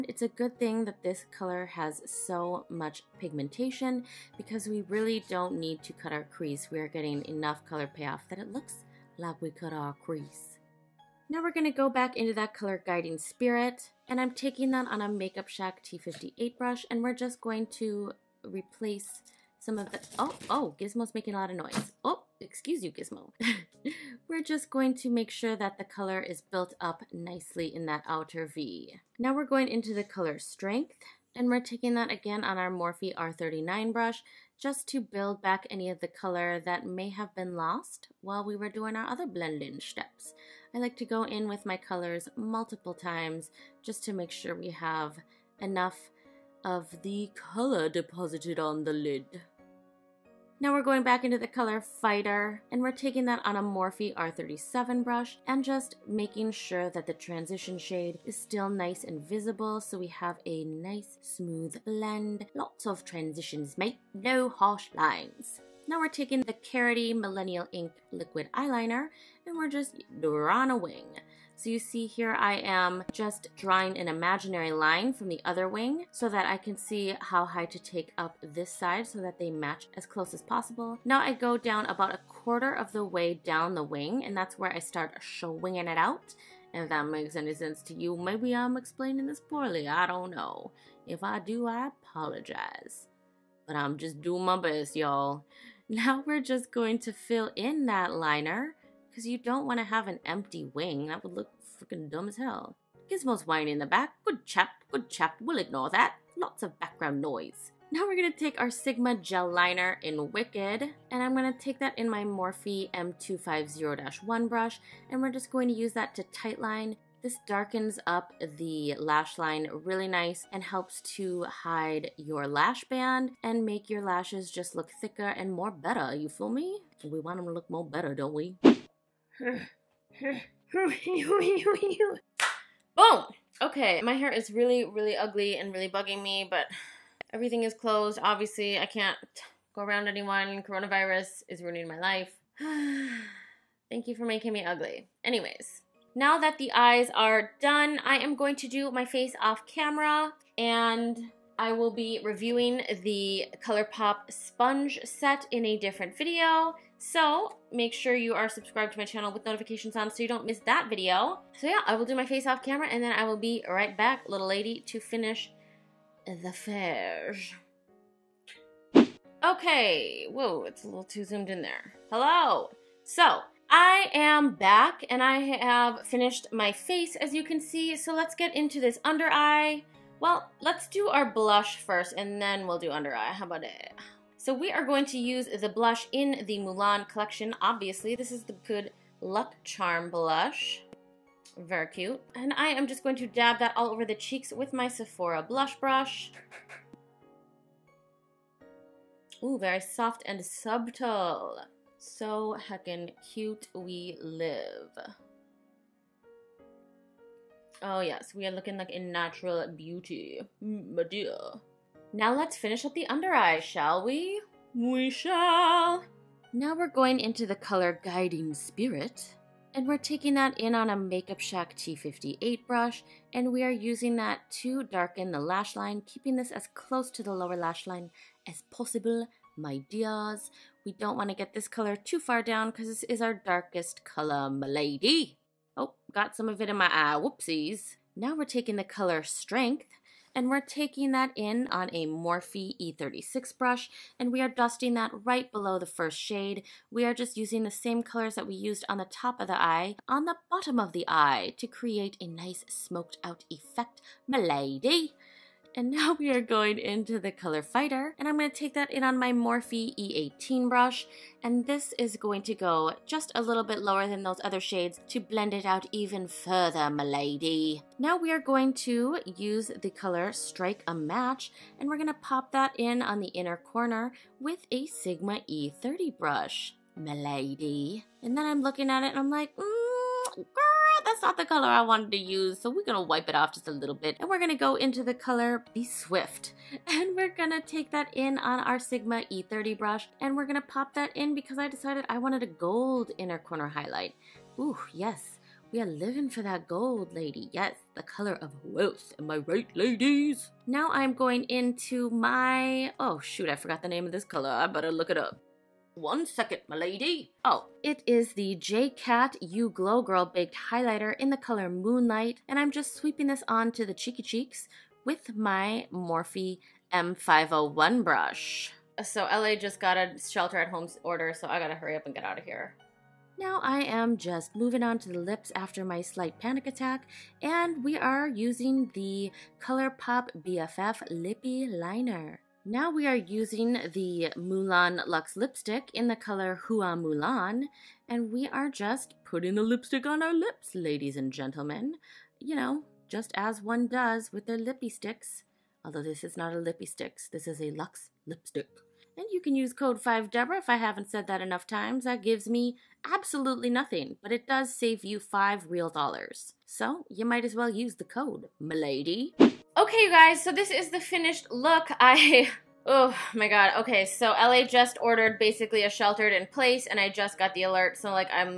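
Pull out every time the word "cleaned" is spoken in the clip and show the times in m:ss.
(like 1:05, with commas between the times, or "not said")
not said.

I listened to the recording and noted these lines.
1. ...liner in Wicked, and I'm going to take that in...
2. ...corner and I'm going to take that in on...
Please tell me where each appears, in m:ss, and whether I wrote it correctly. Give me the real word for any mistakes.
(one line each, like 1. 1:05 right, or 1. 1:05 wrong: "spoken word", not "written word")
1. 1:49 right
2. 4:17 wrong: "fighter", not "corner".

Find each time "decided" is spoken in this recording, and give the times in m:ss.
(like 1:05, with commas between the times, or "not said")
4:51.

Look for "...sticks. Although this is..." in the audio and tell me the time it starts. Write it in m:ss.
5:44.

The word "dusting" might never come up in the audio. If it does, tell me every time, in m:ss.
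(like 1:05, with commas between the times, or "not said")
4:04.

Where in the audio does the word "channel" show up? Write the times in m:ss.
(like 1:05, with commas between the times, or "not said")
2:39.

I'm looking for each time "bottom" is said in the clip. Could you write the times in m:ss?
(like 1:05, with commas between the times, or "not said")
4:10.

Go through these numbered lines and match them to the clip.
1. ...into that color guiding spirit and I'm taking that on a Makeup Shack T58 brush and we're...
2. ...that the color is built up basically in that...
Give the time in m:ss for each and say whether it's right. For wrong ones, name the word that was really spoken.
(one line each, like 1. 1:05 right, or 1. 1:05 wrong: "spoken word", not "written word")
1. 0:12 right
2. 0:25 wrong: "nicely", not "basically".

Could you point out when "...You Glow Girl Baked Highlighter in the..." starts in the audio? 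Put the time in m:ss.
5:09.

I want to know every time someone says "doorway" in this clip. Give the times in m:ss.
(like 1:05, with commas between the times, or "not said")
not said.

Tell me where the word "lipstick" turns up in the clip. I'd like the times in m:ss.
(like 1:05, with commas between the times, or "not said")
5:35, 5:39, 5:48.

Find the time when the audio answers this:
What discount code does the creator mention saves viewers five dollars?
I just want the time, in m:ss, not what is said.
5:50.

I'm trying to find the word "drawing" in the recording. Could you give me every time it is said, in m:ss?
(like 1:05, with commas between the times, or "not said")
1:13.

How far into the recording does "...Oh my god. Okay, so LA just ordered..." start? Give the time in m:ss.
6:02.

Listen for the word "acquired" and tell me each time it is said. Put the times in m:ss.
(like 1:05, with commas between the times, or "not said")
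not said.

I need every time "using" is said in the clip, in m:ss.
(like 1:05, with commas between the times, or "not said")
3:43, 4:07, 5:28, 5:33.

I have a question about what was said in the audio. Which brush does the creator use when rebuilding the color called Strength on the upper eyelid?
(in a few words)
Morphe R39.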